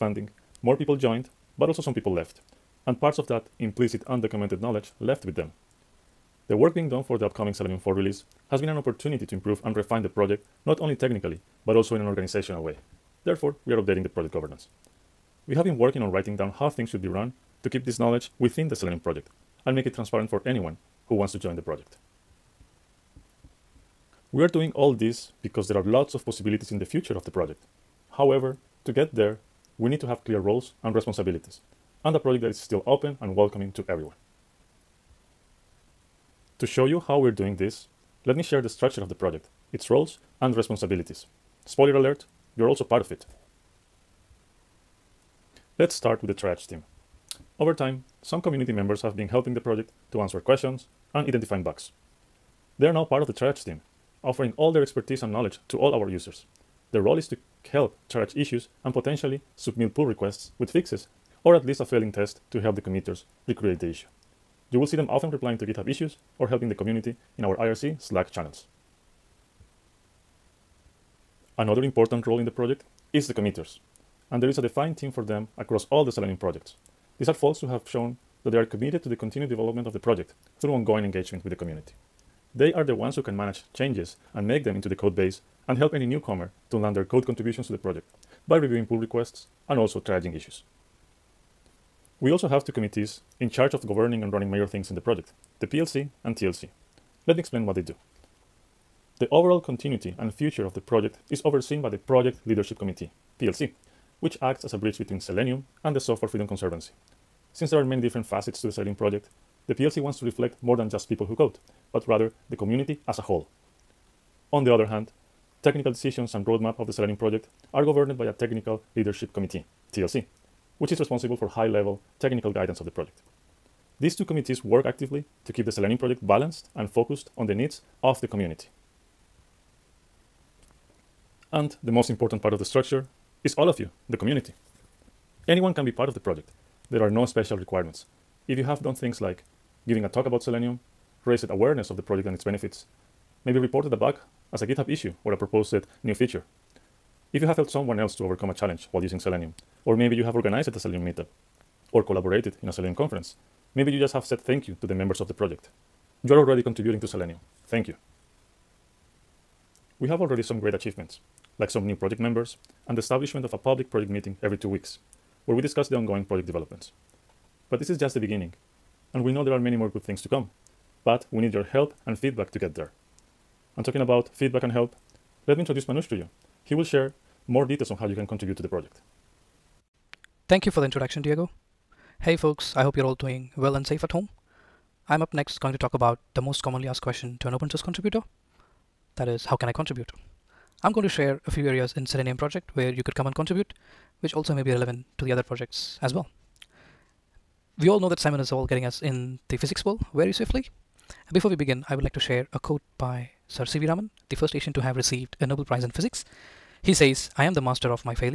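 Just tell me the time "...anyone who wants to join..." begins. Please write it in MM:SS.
00:20.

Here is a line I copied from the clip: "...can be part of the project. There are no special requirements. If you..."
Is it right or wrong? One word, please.
right.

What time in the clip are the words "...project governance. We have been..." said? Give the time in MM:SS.
00:14.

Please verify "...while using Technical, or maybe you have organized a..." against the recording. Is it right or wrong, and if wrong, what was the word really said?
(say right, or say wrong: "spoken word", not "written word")
wrong: "Selenium", not "Technical".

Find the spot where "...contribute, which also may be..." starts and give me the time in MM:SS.
03:13.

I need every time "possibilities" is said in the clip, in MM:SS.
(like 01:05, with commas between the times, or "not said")
00:26.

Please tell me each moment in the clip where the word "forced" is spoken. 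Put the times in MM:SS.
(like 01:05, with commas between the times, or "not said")
not said.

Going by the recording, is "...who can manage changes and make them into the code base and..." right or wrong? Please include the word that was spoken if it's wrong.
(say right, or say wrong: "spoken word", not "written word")
right.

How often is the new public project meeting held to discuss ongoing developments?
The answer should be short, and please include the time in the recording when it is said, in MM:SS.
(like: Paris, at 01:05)
Every two weeks, at 02:44.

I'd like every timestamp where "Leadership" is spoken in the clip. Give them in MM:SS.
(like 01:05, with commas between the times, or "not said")
01:42, 01:58.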